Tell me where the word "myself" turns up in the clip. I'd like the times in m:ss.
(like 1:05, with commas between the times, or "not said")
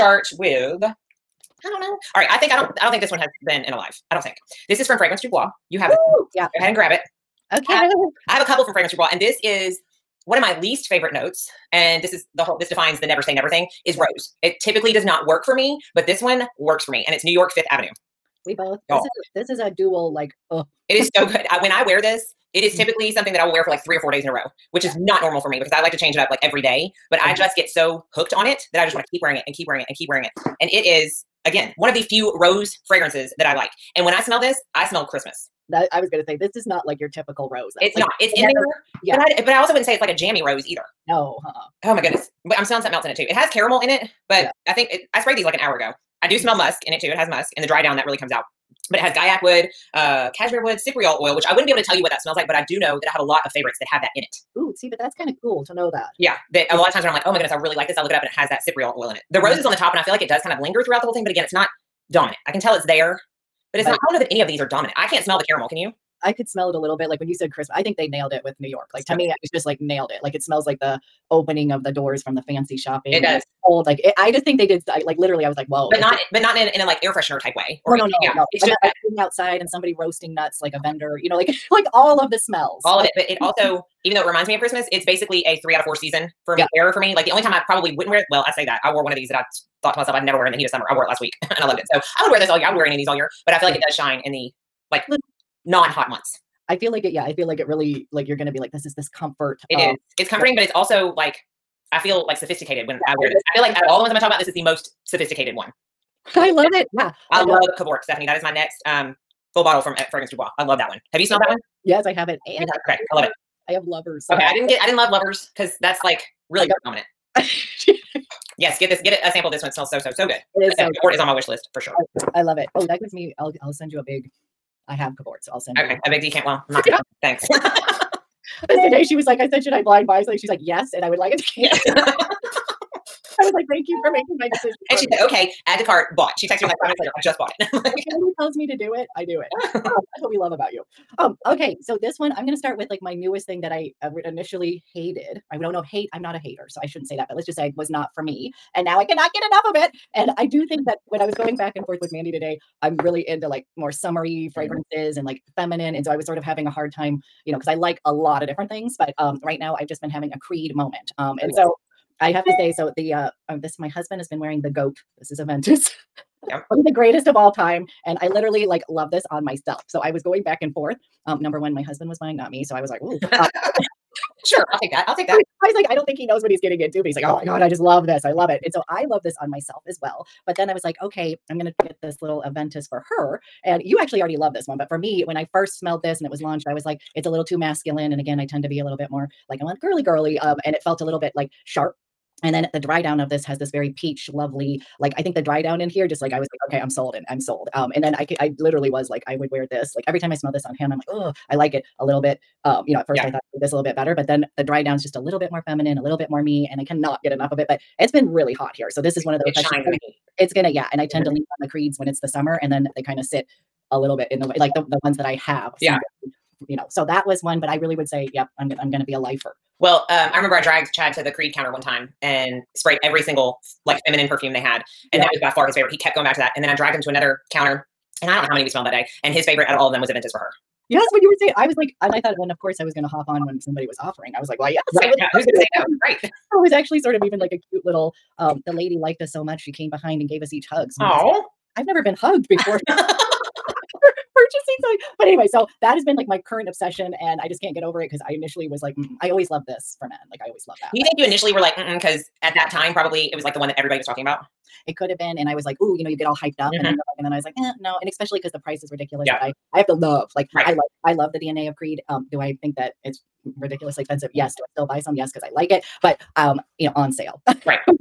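1:29, 2:49, 2:59.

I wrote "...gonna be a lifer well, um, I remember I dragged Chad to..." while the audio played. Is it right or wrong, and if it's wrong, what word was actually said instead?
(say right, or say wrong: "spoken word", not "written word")
right.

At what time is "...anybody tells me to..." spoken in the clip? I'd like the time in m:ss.
2:18.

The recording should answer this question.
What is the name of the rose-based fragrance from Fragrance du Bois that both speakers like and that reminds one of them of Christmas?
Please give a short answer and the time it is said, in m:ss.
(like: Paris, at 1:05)
New York Fifth Avenue, at 0:17.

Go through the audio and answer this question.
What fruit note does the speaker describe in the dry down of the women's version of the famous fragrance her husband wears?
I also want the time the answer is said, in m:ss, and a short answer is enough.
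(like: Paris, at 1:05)
Peach, at 3:13.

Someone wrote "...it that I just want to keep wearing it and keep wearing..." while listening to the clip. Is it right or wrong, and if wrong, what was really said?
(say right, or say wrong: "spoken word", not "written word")
right.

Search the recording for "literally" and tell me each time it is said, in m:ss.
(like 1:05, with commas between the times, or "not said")
1:15, 2:48, 3:18.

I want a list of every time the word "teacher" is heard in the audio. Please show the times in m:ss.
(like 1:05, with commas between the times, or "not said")
not said.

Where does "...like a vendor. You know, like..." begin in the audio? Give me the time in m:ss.
1:20.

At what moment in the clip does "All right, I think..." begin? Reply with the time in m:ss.
0:02.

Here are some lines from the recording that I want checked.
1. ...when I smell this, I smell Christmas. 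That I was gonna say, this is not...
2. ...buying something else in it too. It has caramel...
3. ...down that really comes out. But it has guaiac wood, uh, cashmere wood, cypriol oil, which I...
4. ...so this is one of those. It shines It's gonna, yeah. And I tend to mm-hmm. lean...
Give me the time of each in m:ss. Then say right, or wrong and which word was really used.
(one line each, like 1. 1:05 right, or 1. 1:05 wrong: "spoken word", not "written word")
1. 0:34 right
2. 0:42 wrong: "smelling", not "buying"
3. 0:47 right
4. 3:28 right.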